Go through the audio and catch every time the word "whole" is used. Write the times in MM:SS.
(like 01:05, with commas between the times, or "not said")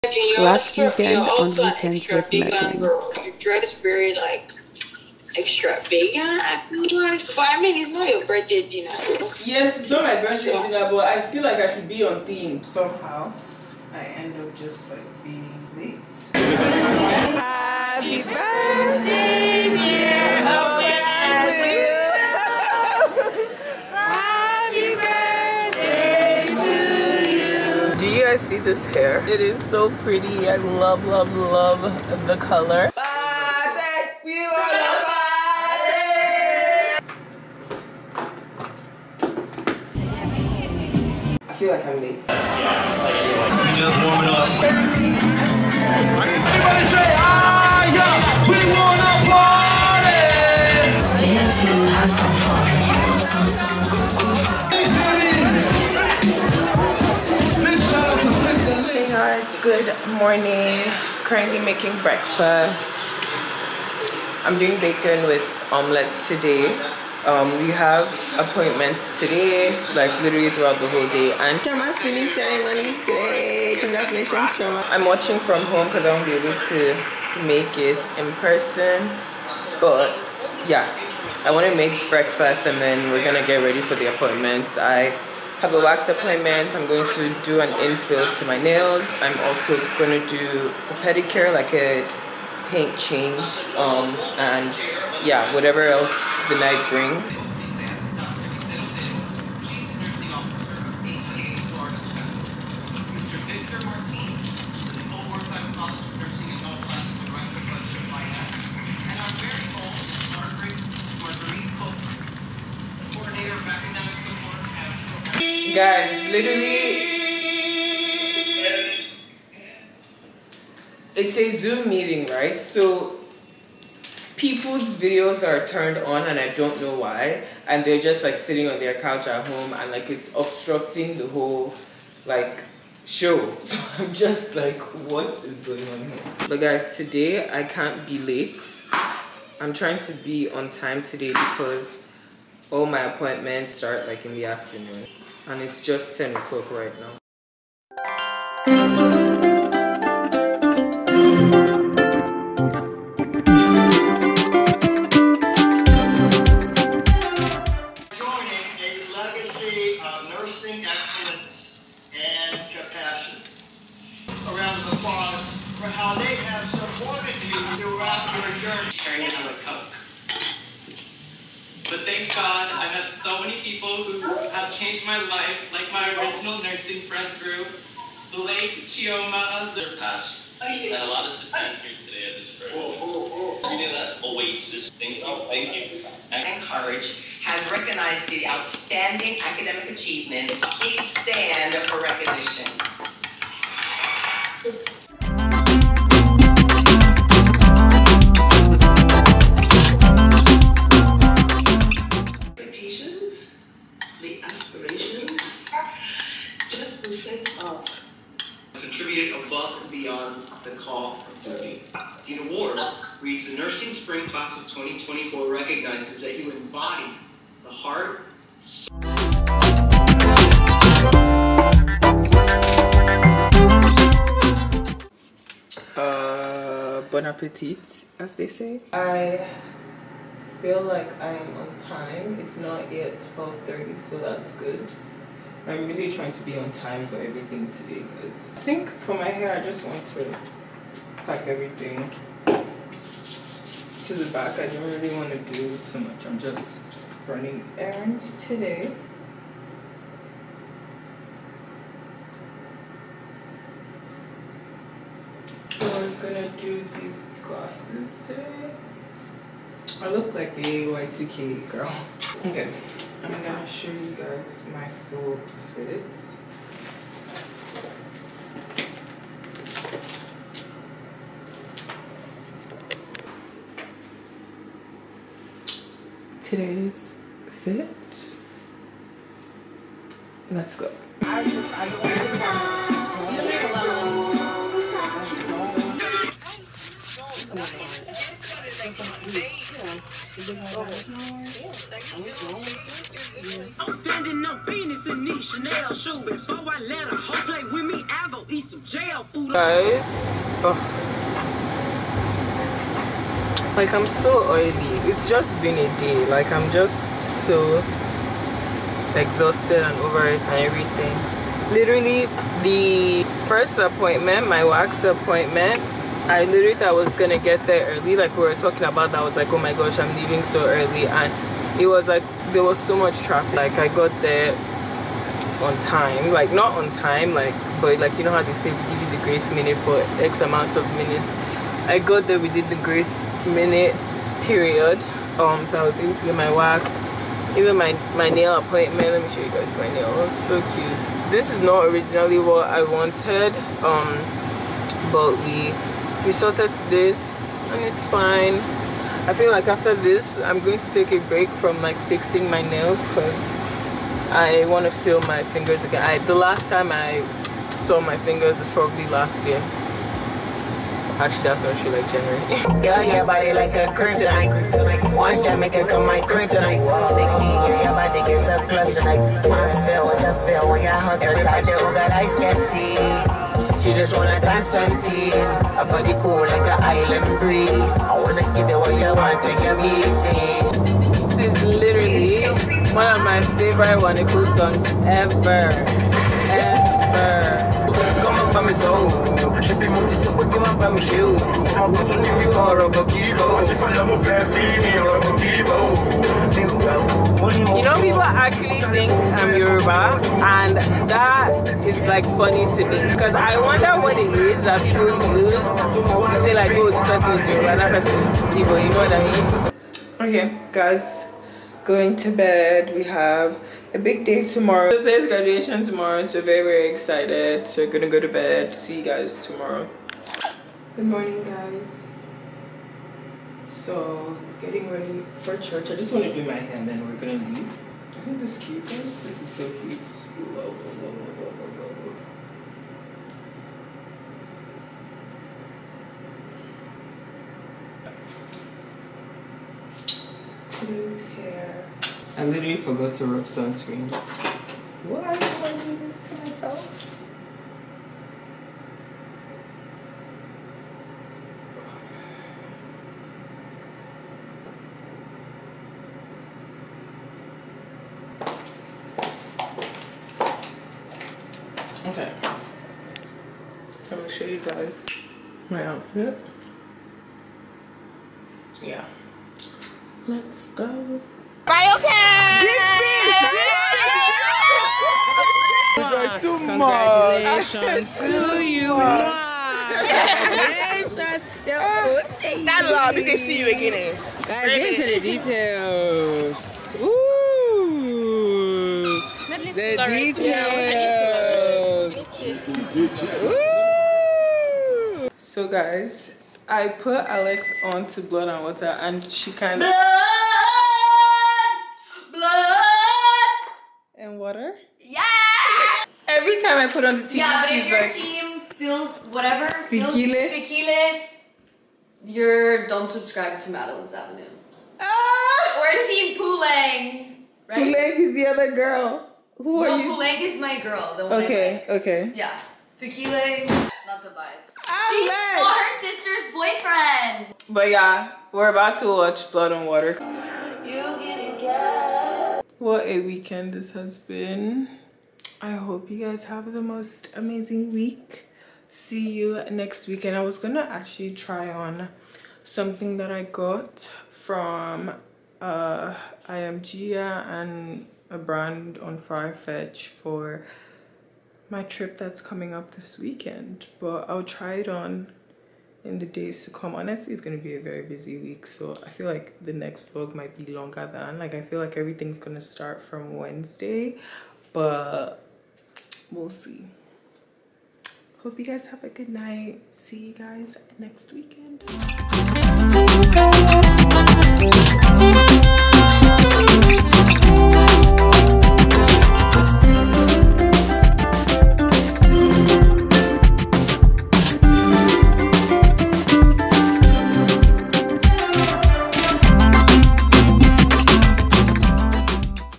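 01:10, 02:11.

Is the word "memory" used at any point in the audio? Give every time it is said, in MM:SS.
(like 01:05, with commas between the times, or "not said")
not said.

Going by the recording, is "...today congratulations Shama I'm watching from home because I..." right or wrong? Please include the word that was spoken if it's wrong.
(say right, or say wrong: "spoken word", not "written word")
right.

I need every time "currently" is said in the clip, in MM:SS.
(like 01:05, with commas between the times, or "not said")
01:01.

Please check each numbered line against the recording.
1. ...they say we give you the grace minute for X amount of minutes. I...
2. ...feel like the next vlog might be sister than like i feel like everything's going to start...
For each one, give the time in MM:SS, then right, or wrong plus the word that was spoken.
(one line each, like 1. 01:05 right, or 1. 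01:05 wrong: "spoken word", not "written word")
1. 05:28 right
2. 09:19 wrong: "longer", not "sister".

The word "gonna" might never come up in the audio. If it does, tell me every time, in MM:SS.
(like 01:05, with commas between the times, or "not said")
01:23, 04:16, 04:23, 05:17, 06:57, 07:07.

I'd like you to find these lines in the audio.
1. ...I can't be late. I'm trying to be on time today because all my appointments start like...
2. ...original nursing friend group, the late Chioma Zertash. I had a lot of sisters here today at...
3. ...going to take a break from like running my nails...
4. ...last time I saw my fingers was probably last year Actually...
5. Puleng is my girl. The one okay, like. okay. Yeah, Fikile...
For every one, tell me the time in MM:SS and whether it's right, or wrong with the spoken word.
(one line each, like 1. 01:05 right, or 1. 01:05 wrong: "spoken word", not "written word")
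1. 02:17 right
2. 02:56 right
3. 05:50 wrong: "fixing", not "running"
4. 05:56 right
5. 08:40 right.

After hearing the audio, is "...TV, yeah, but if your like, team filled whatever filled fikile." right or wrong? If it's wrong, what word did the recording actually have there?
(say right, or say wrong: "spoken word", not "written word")
right.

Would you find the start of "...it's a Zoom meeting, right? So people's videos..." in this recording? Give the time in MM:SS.
02:01.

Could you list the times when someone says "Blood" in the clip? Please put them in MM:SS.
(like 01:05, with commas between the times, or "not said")
08:18, 08:49.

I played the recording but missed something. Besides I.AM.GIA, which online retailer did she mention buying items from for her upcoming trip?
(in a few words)
Farfetch.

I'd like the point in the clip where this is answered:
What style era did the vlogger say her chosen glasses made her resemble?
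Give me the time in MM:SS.
04:20.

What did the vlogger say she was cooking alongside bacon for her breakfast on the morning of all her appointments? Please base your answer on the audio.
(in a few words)
omelette.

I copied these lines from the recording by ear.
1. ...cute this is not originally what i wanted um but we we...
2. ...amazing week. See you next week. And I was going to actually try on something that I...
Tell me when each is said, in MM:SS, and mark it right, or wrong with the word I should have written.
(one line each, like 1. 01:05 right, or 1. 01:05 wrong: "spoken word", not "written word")
1. 05:40 right
2. 08:57 right.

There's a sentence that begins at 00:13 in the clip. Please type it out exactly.
I end up just like being late.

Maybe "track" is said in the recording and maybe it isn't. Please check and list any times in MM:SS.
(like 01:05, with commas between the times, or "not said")
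not said.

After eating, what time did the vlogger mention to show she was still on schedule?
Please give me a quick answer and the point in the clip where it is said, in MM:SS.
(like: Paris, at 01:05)
12.30, at 03:53.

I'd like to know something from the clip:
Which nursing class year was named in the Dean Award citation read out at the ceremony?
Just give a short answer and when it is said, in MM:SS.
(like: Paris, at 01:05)
Spring Class of 2024, at 03:33.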